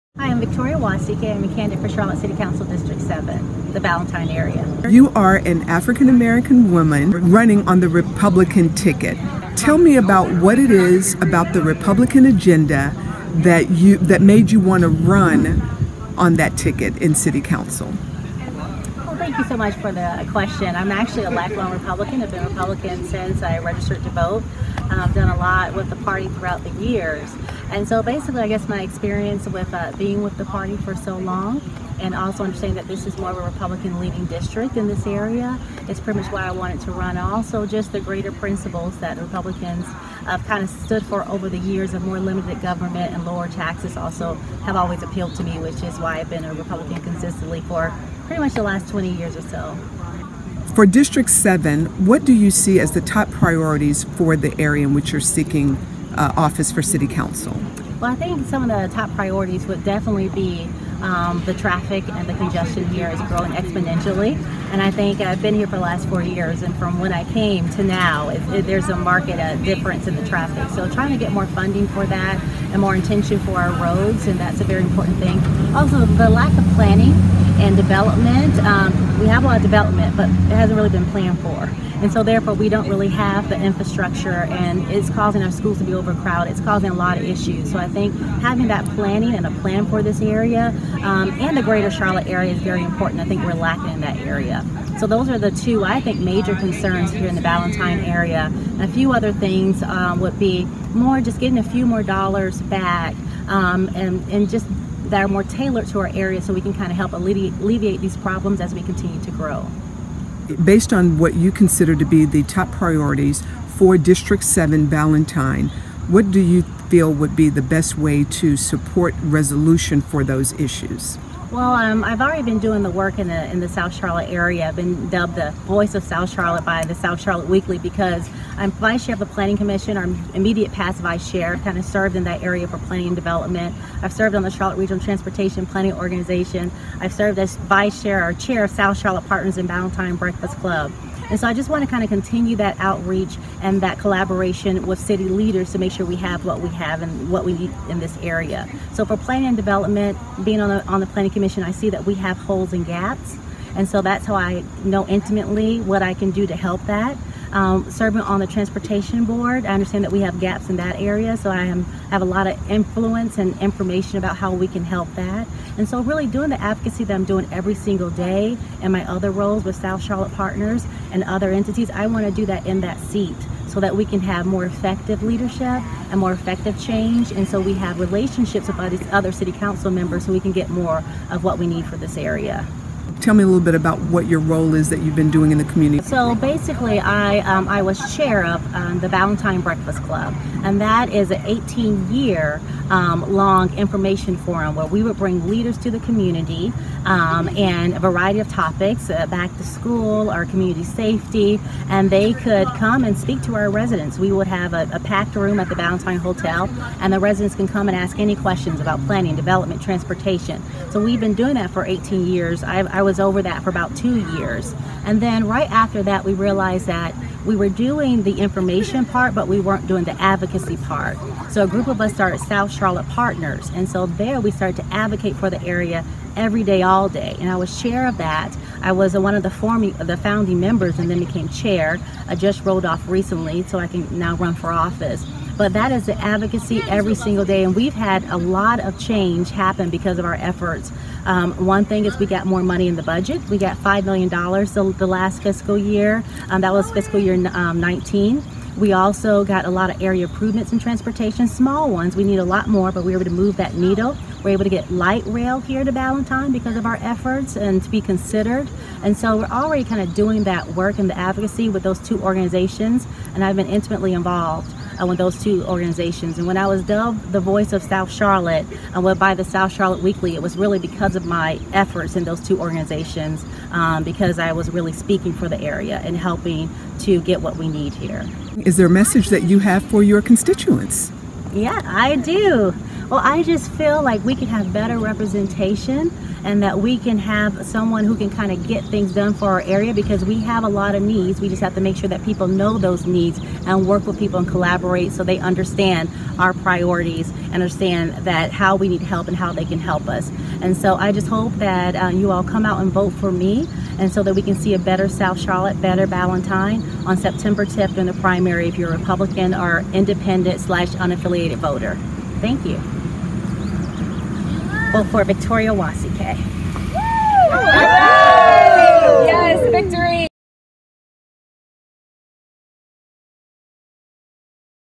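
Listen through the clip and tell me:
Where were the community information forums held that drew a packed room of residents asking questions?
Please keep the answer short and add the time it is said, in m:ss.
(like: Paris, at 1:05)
Ballantyne Hotel, at 3:25.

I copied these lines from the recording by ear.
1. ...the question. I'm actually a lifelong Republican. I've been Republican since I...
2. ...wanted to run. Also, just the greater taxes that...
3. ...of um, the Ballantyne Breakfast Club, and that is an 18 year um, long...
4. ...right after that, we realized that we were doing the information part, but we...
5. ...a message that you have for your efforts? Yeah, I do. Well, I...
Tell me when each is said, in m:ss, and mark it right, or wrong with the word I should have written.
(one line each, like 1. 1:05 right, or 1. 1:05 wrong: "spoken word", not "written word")
1. 0:19 right
2. 0:36 wrong: "principles", not "taxes"
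3. 3:08 right
4. 3:35 right
5. 4:38 wrong: "constituents", not "efforts".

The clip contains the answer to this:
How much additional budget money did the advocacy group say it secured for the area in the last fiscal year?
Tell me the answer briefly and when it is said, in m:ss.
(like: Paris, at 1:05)
$5 million, at 4:03.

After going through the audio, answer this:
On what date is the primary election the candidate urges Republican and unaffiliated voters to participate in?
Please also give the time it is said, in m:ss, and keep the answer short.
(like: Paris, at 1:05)
September 10th, at 5:07.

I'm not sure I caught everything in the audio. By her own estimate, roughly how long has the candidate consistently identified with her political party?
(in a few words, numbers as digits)
20 years.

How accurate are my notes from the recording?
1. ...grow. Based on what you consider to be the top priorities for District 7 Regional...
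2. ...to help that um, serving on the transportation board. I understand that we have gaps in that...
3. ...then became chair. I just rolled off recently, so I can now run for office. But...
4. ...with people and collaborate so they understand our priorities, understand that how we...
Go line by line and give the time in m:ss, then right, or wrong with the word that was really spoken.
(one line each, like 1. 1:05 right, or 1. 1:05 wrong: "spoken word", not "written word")
1. 1:49 wrong: "Ballantyne", not "Regional"
2. 2:36 right
3. 3:51 right
4. 4:54 right.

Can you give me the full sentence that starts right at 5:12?
Thank you vote for Victoria Nwasike.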